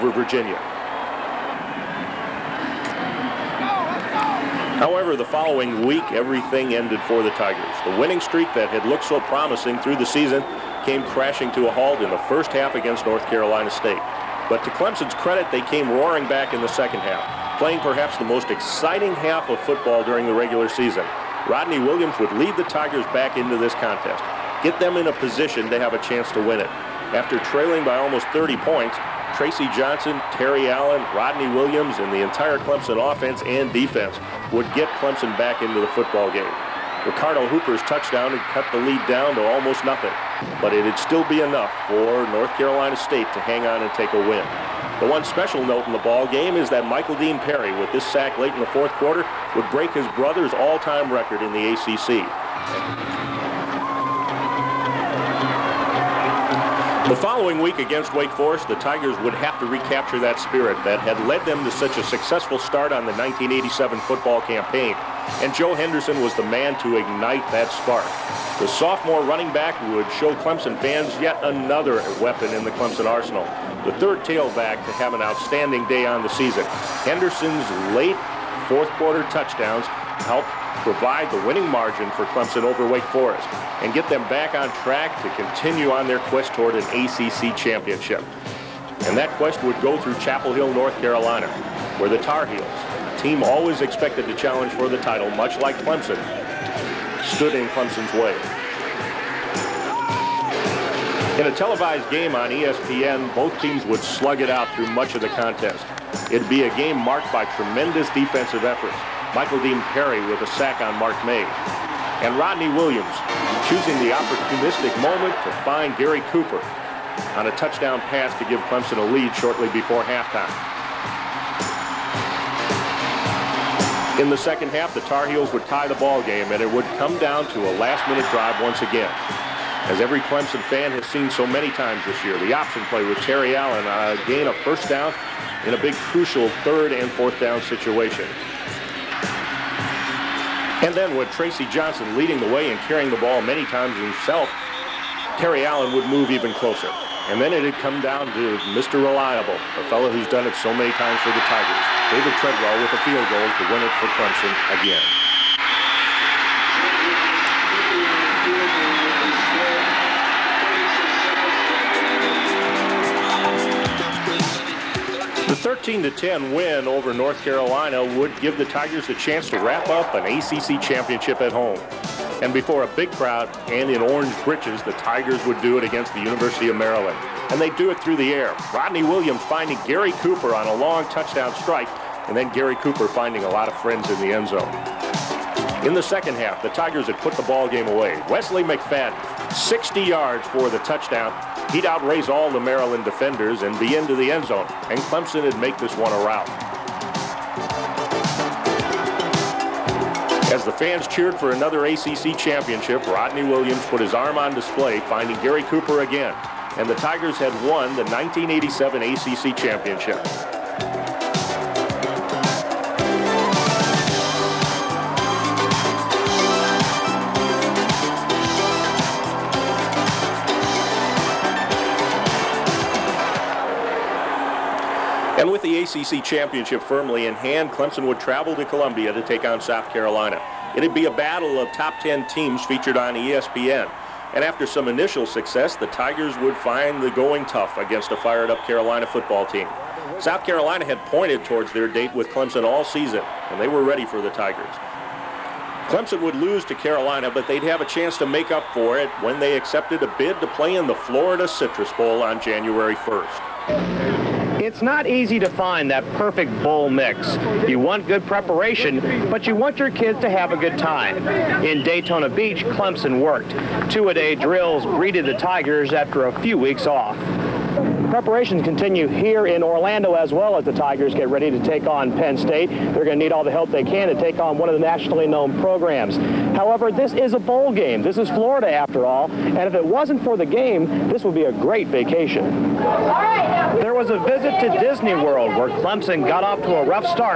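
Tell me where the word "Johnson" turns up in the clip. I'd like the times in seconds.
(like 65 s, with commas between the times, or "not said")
29 s, 141 s.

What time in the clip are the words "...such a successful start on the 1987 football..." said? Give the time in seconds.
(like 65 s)
61 s.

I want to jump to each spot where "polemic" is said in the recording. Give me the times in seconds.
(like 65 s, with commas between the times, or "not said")
not said.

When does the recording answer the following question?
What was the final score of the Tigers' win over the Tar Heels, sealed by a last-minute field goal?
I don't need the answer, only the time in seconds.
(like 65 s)
165 s.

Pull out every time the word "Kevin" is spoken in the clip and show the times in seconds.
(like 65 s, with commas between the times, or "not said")
not said.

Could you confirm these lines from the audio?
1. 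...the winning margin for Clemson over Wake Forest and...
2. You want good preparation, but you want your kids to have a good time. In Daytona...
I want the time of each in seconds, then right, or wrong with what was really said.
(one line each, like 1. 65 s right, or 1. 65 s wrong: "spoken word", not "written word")
1. 81 s right
2. 257 s right.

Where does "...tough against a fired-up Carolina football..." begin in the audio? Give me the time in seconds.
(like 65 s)
237 s.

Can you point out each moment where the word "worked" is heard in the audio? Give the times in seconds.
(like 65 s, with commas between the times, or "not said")
263 s.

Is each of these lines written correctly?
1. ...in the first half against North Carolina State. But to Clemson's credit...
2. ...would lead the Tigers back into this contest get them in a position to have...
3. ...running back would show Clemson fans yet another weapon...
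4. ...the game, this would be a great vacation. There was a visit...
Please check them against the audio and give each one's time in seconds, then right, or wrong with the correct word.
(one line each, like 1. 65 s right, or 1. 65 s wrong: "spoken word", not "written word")
1. 12 s right
2. 22 s right
3. 69 s right
4. 280 s right.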